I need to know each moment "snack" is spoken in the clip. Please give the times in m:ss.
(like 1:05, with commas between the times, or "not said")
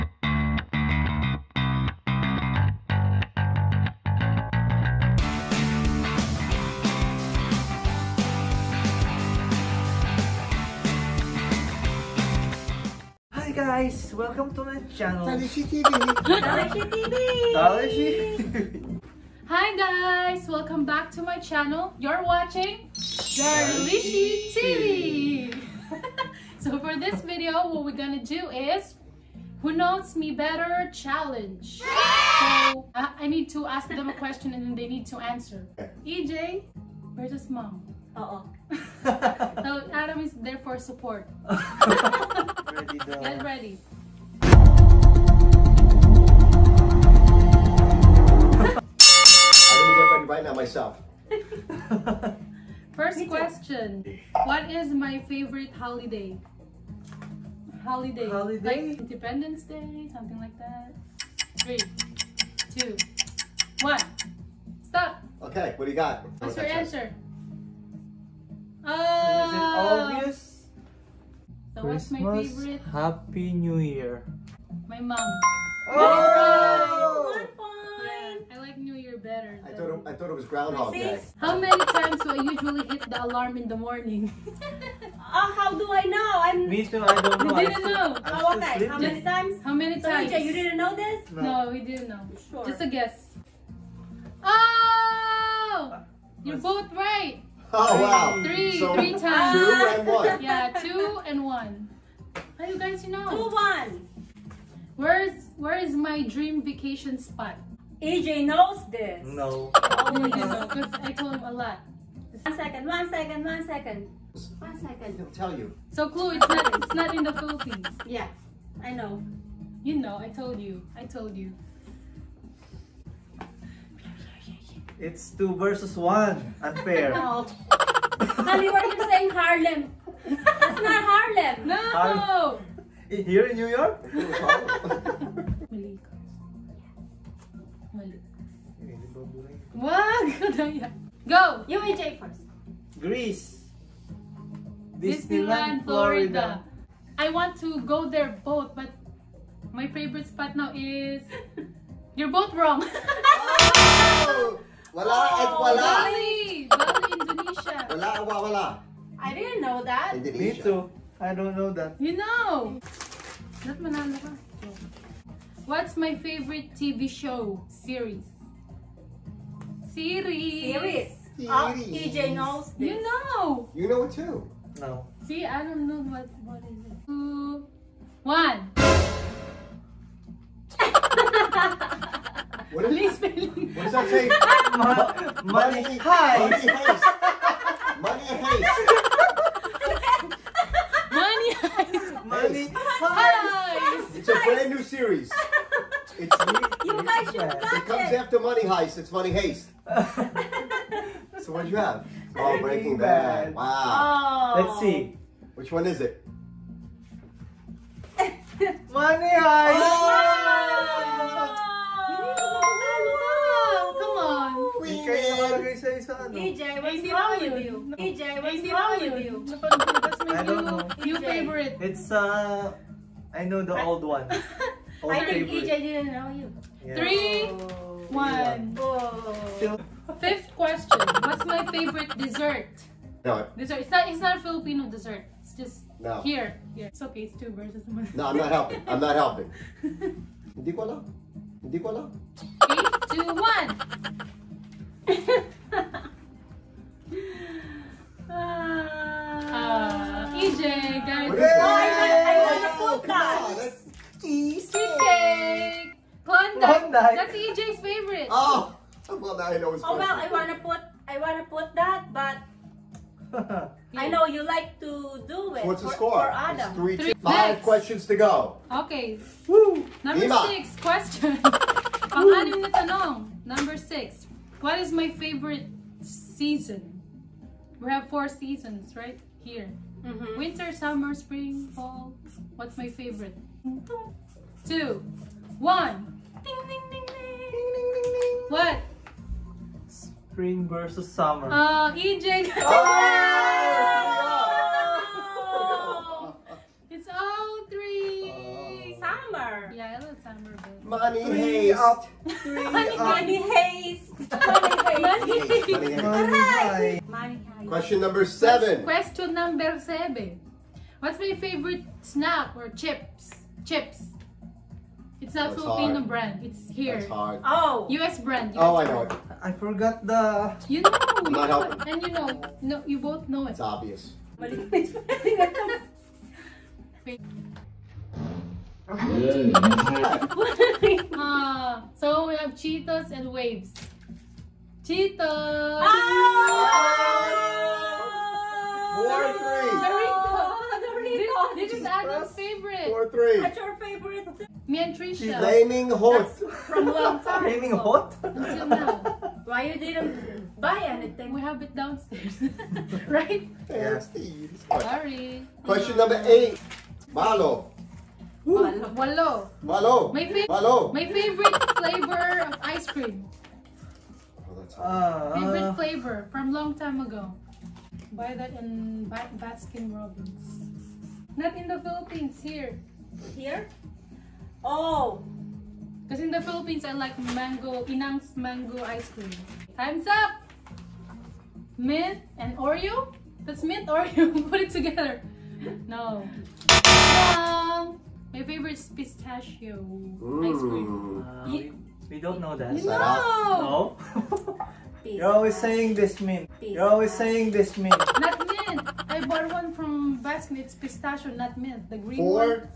5:11.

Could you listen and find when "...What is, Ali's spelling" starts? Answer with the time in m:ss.
3:02.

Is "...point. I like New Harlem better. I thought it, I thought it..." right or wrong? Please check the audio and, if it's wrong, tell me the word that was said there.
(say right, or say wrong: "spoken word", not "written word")
wrong: "Year", not "Harlem".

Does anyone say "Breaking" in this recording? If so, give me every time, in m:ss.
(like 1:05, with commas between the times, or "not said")
3:22.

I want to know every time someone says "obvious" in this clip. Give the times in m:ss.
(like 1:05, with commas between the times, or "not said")
1:10, 5:23.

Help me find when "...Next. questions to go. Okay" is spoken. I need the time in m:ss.
4:27.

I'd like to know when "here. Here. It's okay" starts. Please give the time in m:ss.
3:56.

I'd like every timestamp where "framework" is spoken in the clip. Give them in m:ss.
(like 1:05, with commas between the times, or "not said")
not said.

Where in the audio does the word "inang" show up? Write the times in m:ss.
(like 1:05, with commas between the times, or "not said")
6:17.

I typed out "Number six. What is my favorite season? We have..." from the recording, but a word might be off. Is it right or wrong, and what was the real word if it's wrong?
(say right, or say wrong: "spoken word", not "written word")
right.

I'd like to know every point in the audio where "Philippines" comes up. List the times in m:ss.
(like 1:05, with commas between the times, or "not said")
1:57, 6:11, 6:16.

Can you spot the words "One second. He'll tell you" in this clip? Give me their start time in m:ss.
1:54.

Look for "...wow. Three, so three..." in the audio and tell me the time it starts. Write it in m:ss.
1:38.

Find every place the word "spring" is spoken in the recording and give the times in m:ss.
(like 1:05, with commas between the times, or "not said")
4:41, 4:50.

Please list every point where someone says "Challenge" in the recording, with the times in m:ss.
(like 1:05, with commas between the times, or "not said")
0:30.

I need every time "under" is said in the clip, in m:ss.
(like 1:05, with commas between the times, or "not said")
not said.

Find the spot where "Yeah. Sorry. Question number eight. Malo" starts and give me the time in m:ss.
5:53.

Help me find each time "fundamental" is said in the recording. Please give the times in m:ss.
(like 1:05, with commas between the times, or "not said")
not said.